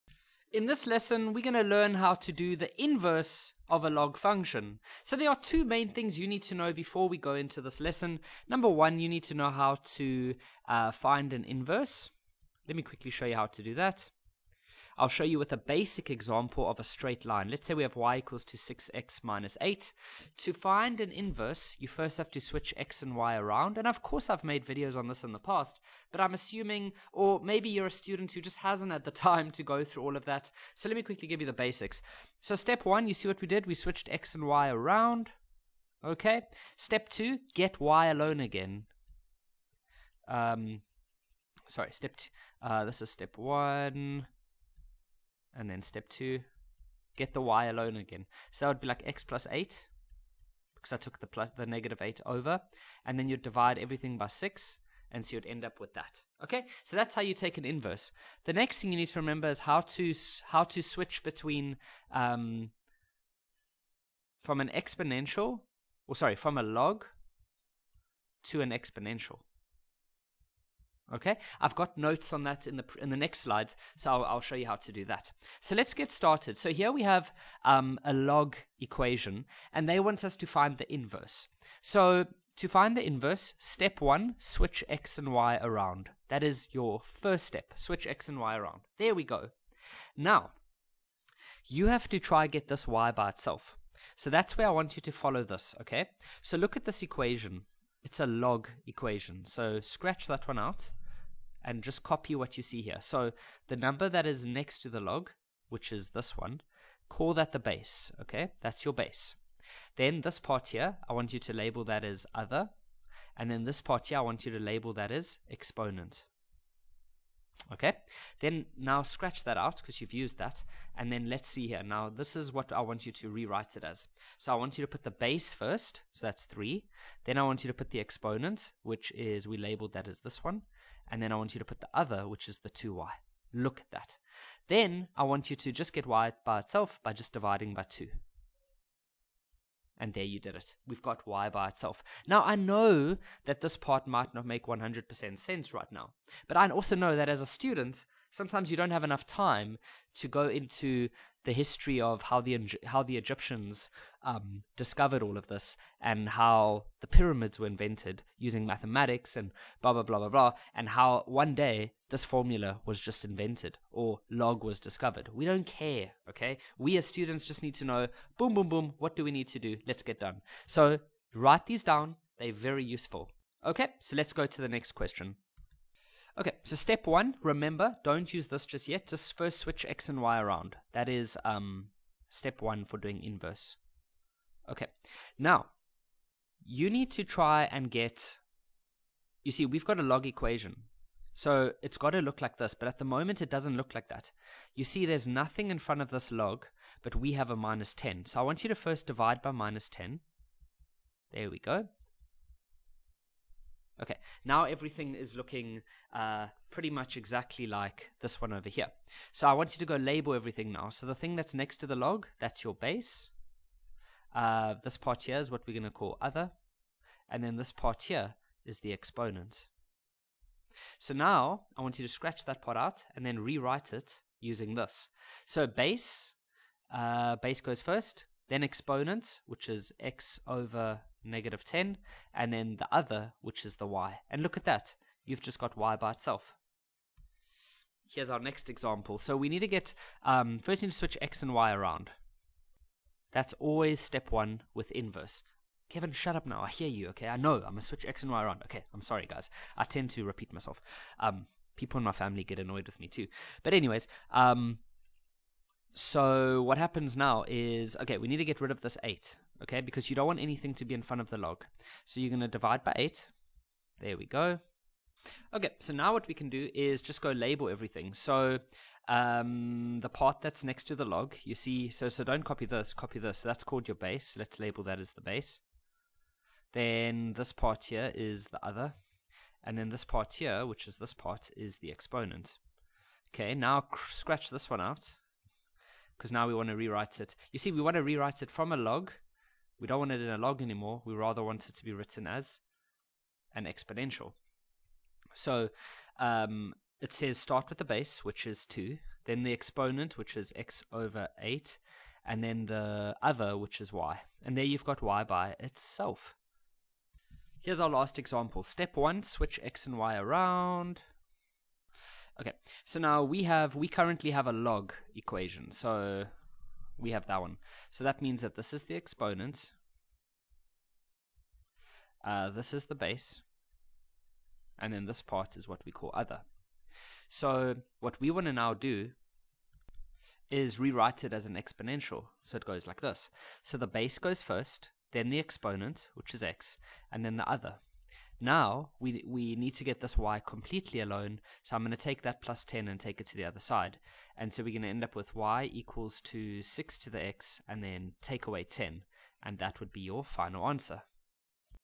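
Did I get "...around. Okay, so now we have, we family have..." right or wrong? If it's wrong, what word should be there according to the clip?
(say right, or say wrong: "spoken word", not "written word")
wrong: "currently", not "family".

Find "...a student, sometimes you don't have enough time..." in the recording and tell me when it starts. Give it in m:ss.
2:27.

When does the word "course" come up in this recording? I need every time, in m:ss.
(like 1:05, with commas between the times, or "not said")
0:24.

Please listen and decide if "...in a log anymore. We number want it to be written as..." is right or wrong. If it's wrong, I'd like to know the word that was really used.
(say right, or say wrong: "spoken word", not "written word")
wrong: "rather", not "number".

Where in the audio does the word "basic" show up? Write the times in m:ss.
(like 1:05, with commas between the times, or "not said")
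0:15, 0:31.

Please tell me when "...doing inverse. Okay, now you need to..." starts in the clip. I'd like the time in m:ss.
3:02.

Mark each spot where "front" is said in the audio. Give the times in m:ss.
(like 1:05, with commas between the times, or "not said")
3:15, 4:21.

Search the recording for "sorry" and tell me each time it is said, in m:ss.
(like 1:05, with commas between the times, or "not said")
0:41, 1:06, 4:09.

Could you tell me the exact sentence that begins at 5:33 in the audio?
So the base goes first, then the exponent, which is x, and then the other.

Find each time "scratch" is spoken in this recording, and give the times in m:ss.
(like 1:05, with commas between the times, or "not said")
1:39, 1:59, 3:42, 4:44.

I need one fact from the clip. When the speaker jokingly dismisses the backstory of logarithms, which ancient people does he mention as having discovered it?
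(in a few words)
the Egyptians.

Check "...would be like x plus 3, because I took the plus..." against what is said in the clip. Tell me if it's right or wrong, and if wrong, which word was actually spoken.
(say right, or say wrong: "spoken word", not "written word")
wrong: "8", not "3".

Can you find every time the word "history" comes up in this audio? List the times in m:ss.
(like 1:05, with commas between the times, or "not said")
2:31.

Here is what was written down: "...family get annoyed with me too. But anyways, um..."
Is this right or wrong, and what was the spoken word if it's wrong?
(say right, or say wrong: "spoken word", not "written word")
right.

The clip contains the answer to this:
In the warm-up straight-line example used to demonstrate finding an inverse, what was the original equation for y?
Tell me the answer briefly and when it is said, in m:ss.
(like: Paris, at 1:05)
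y = 6x - 8, at 0:17.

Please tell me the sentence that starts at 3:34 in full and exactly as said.
Uh, this part here is what we're going to call other.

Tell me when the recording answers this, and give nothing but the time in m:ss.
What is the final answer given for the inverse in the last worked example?
5:45.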